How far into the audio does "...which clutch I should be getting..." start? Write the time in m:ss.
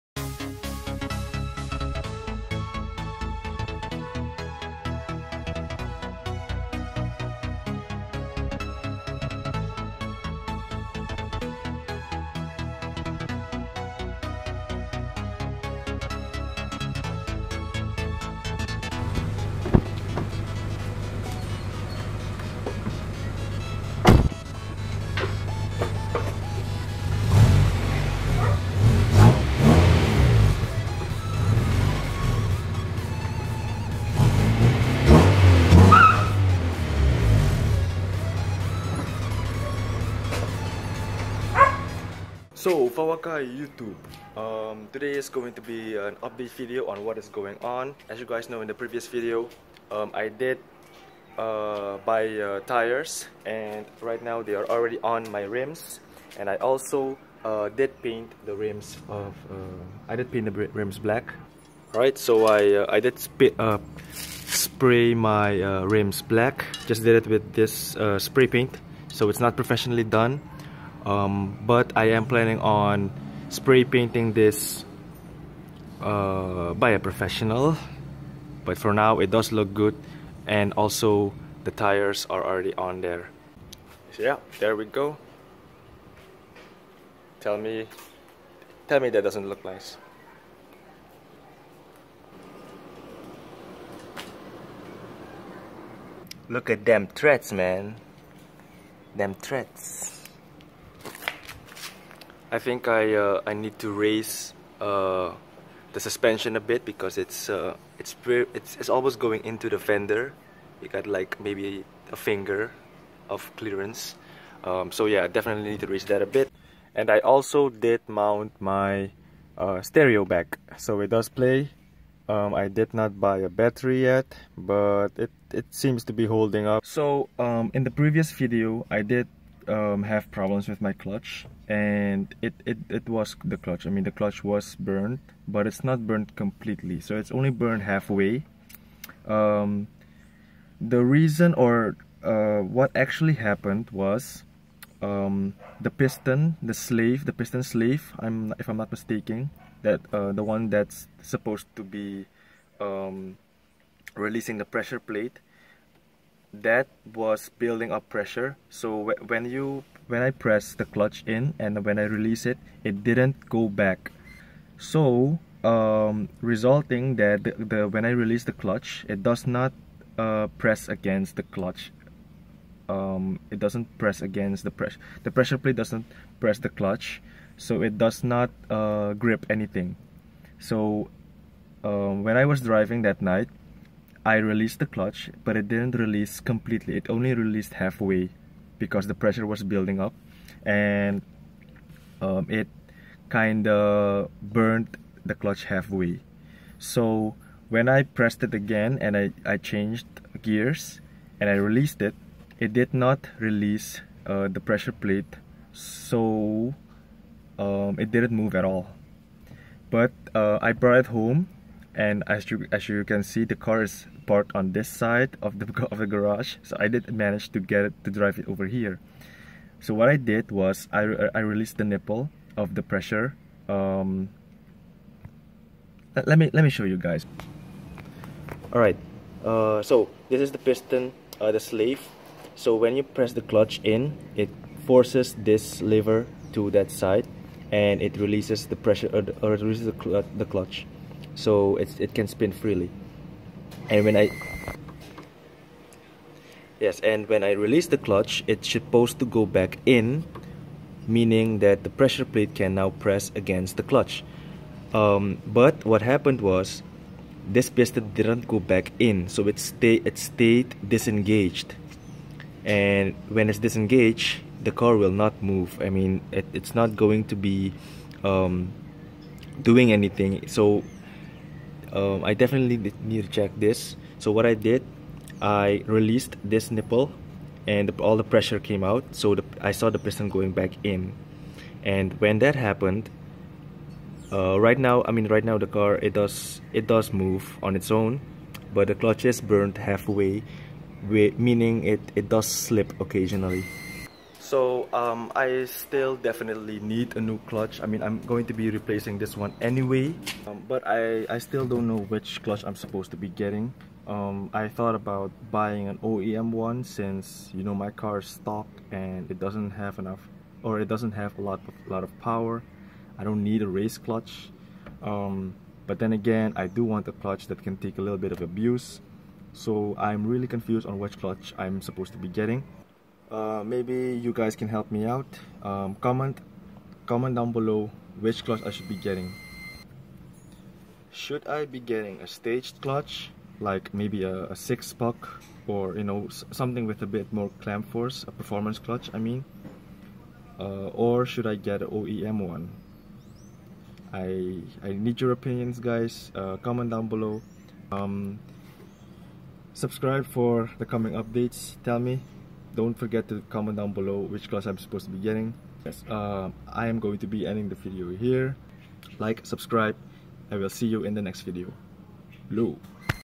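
5:28.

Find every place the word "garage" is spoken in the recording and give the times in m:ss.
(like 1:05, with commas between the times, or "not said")
3:36.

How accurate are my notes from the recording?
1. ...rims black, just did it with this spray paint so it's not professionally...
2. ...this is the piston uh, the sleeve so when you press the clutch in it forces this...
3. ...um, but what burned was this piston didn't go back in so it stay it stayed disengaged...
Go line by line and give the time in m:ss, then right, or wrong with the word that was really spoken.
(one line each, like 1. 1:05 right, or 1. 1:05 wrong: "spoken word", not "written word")
1. 1:05 right
2. 3:50 right
3. 4:14 wrong: "happened", not "burned".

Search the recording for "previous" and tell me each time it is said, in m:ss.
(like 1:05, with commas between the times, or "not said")
0:48, 2:07.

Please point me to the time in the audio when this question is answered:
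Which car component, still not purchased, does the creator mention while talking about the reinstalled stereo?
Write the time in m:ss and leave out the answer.
2:03.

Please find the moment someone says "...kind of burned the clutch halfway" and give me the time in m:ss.
3:13.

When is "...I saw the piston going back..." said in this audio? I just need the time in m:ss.
4:39.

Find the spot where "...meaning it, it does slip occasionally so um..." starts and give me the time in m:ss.
4:51.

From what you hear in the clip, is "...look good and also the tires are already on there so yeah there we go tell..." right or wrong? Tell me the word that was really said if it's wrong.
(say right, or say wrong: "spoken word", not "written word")
right.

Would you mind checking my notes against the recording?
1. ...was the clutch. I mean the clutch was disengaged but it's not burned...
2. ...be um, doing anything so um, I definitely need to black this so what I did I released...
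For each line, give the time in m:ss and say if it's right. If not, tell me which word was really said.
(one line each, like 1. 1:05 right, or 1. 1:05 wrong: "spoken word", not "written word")
1. 2:13 wrong: "burned", not "disengaged"
2. 4:27 wrong: "check", not "black".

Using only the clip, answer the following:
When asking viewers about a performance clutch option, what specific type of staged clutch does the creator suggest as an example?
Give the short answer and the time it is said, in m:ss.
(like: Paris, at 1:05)
Six puck, at 5:34.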